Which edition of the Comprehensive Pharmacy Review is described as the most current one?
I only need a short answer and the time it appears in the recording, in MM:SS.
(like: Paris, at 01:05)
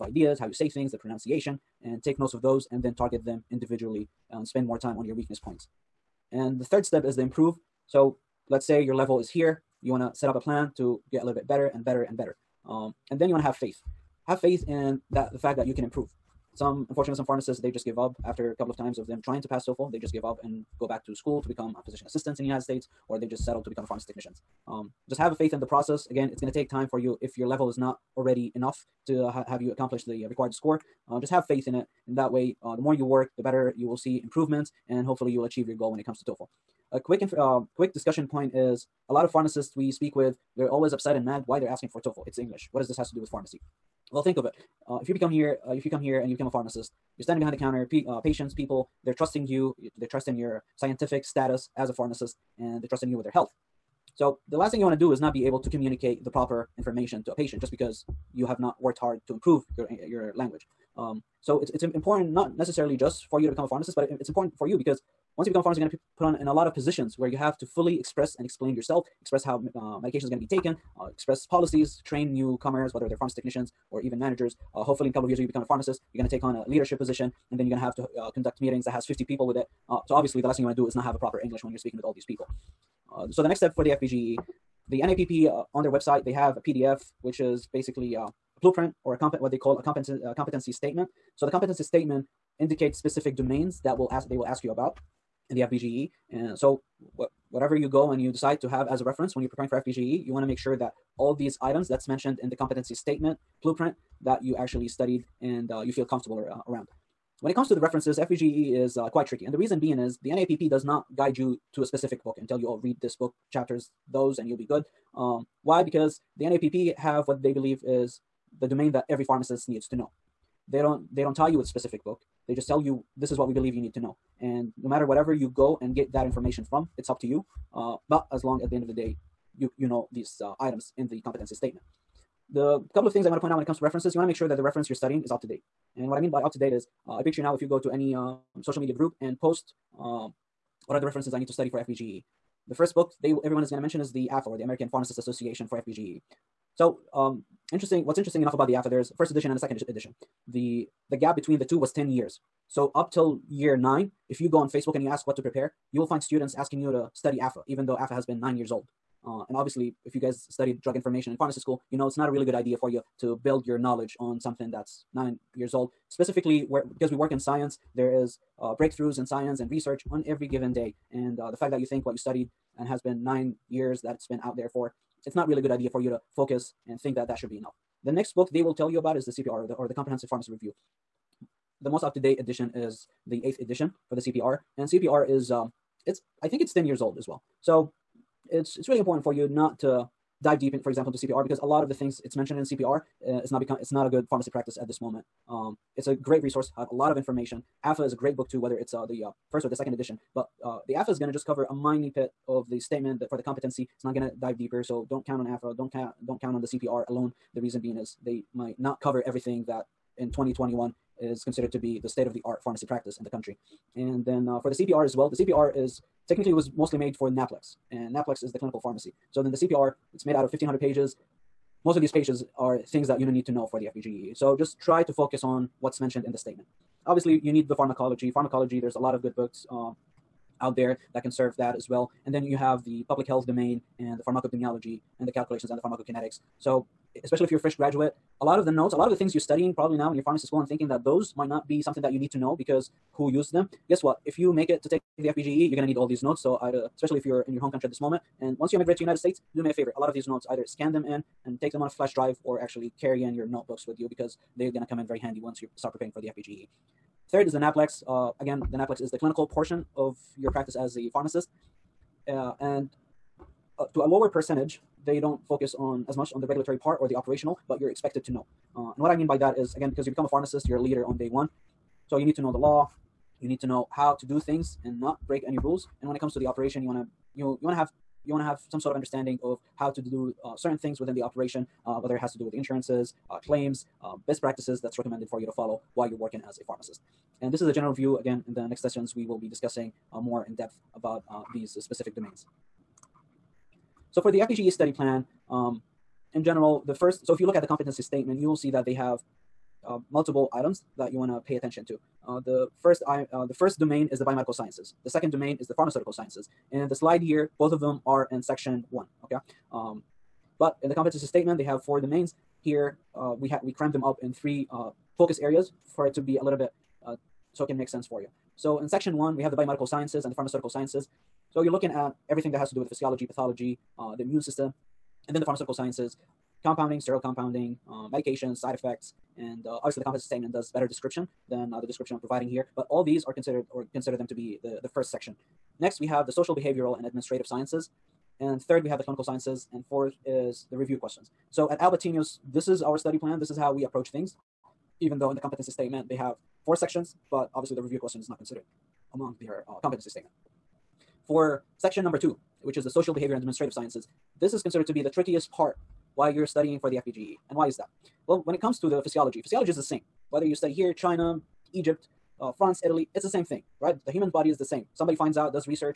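eighth, at 03:03.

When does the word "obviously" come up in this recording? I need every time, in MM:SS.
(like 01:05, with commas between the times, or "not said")
01:20, 02:39, 03:47, 05:29, 05:47.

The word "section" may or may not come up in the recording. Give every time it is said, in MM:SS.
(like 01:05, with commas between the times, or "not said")
05:08, 05:18, 05:35, 05:46, 05:51.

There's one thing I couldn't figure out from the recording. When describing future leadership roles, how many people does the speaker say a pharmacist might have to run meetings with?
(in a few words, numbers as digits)
50.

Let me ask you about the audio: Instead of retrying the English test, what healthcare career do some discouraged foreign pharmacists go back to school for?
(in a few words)
physician assistant.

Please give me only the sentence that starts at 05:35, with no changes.
Next, we have the social, behavioral, and administrative sciences.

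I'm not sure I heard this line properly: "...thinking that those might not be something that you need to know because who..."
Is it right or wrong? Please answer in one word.
right.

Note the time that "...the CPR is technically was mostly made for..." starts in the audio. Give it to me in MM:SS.
03:35.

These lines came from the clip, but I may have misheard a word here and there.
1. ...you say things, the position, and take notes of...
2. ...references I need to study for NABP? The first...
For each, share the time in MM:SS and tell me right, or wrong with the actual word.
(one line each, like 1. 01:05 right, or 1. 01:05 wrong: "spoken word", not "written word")
1. 00:00 wrong: "pronunciation", not "position"
2. 02:21 wrong: "FPGE", not "NABP".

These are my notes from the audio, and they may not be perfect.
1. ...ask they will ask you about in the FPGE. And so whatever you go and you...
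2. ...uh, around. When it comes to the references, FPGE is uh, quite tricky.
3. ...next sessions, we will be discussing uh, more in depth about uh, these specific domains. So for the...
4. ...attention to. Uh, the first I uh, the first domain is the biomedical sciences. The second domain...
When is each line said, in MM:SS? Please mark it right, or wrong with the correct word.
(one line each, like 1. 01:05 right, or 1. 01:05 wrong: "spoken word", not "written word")
1. 01:34 right
2. 01:46 right
3. 04:48 right
4. 05:01 right.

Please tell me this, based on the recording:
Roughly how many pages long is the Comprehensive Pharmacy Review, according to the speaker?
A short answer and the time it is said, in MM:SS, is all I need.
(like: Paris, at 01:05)
1,500, at 03:40.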